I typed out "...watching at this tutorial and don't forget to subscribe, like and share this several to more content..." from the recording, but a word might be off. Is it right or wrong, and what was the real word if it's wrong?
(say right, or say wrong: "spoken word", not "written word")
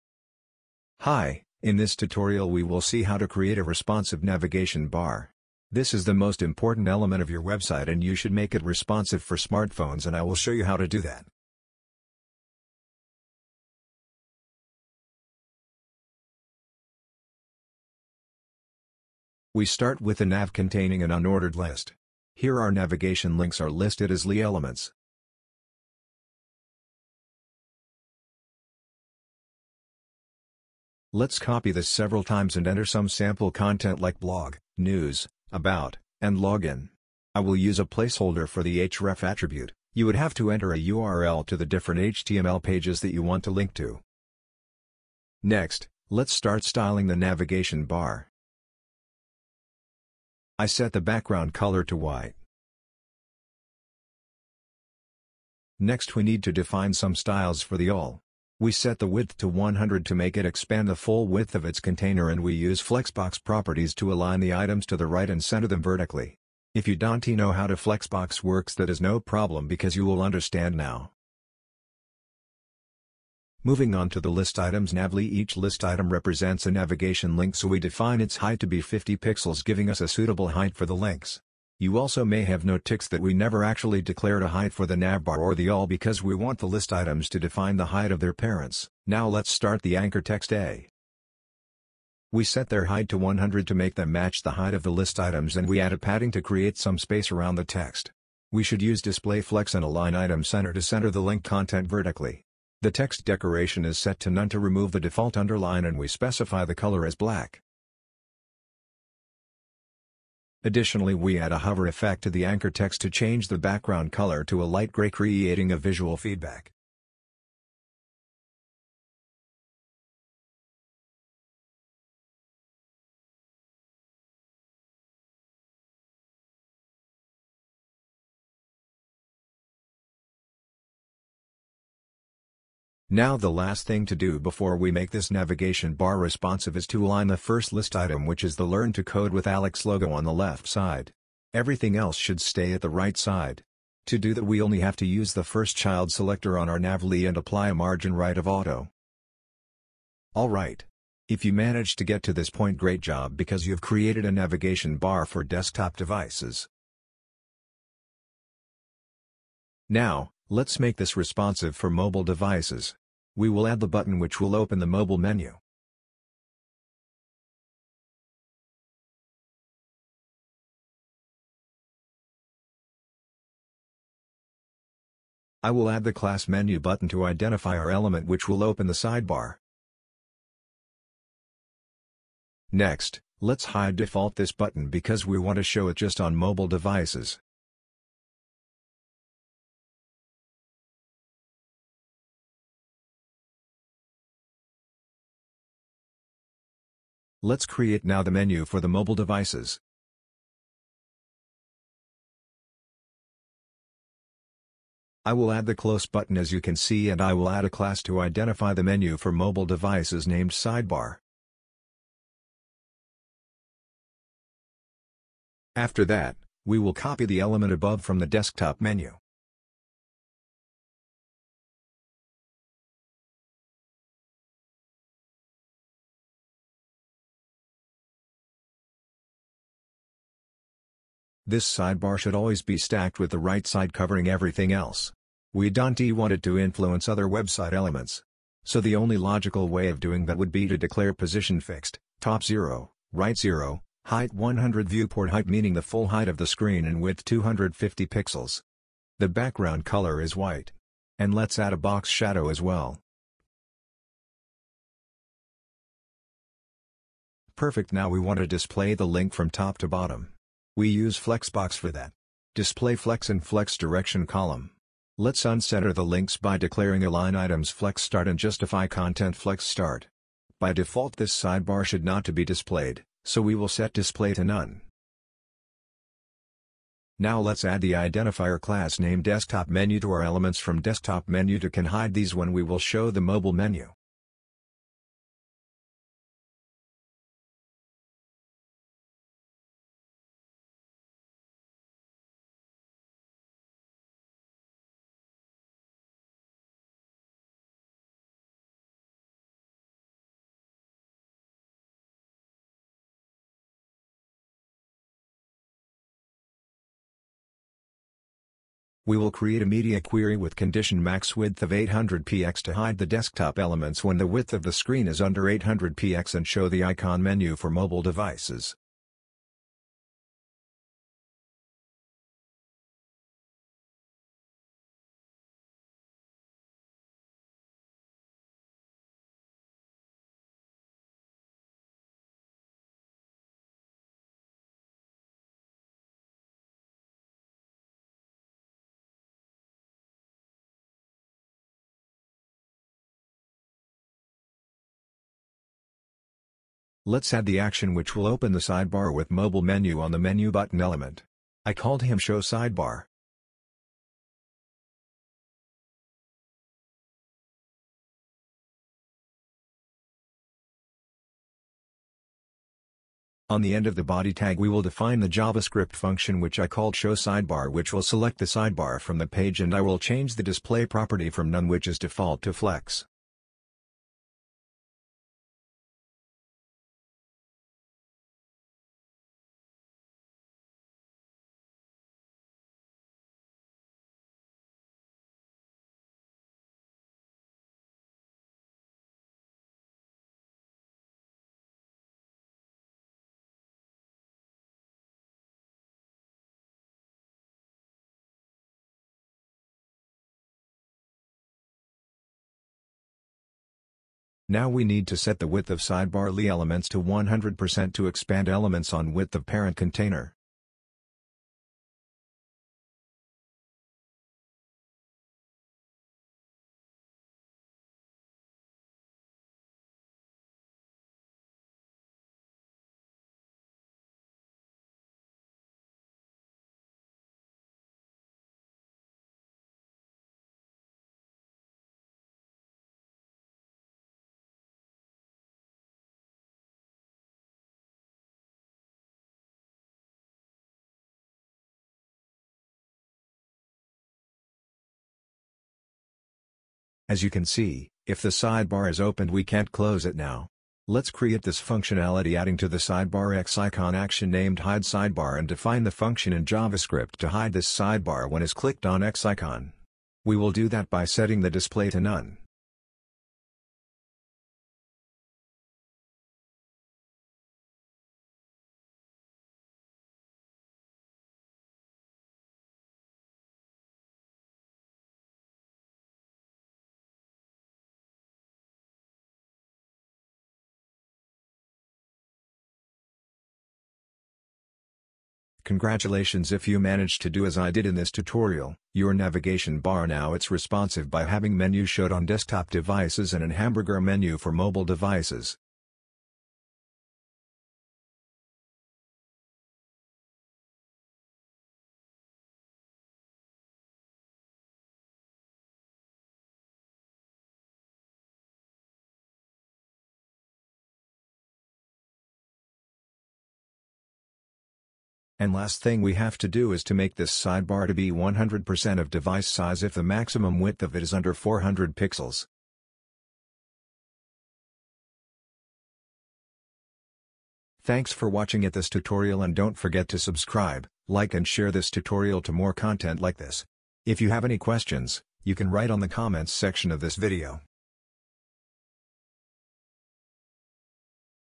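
wrong: "tutorial", not "several".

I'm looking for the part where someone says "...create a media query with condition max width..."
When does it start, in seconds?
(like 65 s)
309 s.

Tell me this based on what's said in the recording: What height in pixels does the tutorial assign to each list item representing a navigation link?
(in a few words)
50 pixels.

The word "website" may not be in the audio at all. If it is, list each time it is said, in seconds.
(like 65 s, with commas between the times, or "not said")
7 s, 237 s.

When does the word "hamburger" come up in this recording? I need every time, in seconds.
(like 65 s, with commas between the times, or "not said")
493 s.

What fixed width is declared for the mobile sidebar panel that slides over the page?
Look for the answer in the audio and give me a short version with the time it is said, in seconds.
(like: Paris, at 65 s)
250 pixels, at 247 s.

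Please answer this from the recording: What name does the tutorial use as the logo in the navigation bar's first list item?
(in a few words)
Learn to Code with Alex.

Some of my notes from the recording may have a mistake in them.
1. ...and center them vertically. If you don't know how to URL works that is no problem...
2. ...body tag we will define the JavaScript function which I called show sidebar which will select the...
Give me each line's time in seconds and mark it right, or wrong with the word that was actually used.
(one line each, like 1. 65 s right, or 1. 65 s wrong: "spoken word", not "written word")
1. 65 s wrong: "Flexbox", not "URL"
2. 364 s right.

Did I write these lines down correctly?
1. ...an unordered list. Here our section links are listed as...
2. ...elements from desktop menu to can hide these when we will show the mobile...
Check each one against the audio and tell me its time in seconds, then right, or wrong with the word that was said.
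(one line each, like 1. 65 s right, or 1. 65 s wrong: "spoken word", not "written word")
1. 21 s wrong: "navigation", not "section"
2. 280 s right.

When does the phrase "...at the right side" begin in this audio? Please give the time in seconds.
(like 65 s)
142 s.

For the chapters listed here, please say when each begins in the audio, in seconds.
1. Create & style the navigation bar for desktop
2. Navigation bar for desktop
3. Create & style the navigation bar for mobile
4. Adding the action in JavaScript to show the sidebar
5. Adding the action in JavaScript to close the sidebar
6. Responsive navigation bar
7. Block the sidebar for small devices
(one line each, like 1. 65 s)
1. 20 s
2. 152 s
3. 165 s
4. 348 s
5. 448 s
6. 495 s
7. 519 s.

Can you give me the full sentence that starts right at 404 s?
Now we need to set the width of sidebar li elements to 100% to expand elements on width of parent container.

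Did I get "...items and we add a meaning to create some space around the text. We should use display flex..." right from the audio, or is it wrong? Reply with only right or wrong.
wrong.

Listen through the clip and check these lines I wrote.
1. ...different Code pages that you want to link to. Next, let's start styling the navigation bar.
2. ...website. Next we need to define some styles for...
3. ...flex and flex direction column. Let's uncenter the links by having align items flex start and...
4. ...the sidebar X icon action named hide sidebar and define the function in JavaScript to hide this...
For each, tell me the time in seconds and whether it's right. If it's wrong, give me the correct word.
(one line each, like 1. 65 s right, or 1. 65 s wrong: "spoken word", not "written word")
1. 41 s wrong: "HTML", not "Code"
2. 51 s wrong: "white", not "website"
3. 262 s wrong: "declaring", not "having"
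4. 452 s right.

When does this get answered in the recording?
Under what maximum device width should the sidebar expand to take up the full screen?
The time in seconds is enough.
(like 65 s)
521 s.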